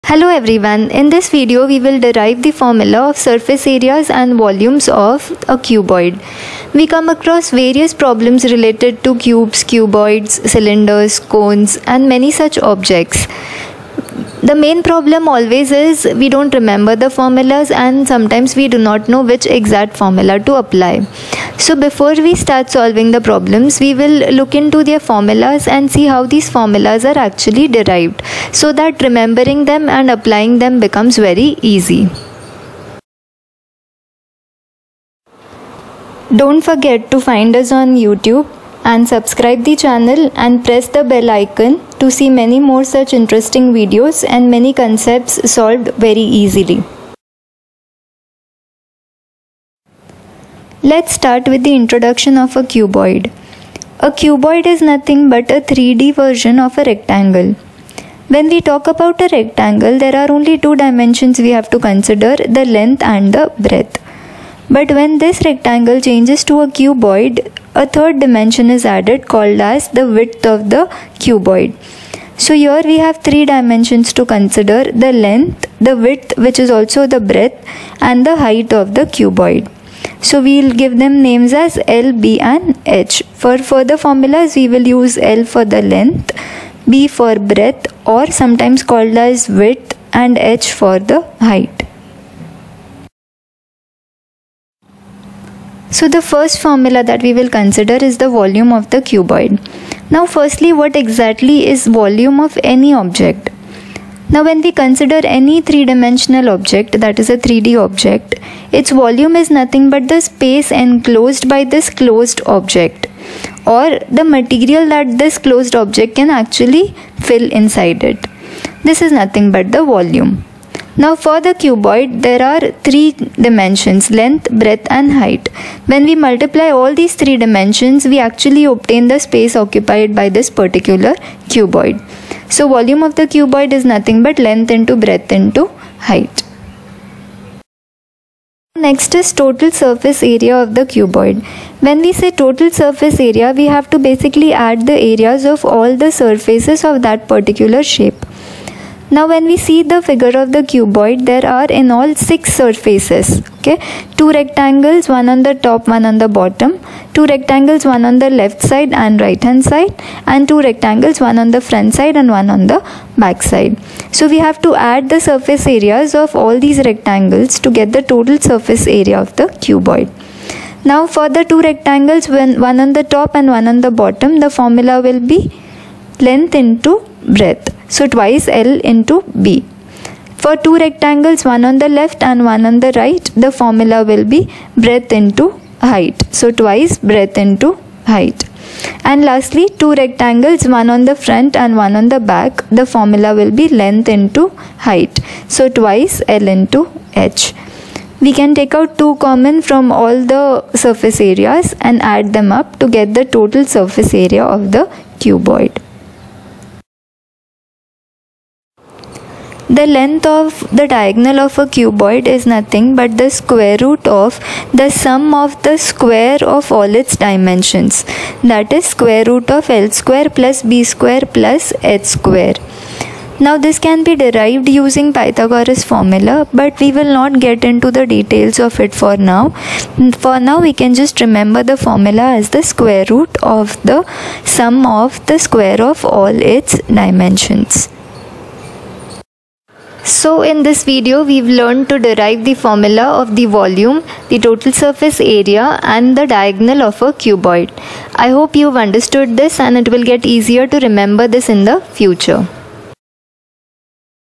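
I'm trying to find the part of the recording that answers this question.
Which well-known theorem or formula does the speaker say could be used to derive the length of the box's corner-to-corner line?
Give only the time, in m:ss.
3:45.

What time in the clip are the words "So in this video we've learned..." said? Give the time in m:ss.
4:00.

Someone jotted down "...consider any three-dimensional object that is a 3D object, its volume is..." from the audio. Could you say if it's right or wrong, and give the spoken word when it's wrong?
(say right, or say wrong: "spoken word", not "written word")
right.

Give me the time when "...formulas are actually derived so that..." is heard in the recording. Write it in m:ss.
0:26.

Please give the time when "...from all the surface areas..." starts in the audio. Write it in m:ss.
3:19.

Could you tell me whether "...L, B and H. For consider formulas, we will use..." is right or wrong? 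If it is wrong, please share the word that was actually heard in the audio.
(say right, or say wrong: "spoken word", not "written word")
wrong: "further", not "consider".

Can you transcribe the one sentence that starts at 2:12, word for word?
So volume of the cuboid is nothing but length into breadth into height.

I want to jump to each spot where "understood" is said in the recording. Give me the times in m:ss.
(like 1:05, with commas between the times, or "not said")
4:08.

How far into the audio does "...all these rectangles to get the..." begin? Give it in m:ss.
2:46.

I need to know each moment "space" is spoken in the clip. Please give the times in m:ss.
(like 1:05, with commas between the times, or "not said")
1:50, 2:09.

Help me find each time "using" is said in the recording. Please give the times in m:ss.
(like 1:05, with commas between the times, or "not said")
3:44.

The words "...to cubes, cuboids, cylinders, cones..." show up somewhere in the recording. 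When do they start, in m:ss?
0:09.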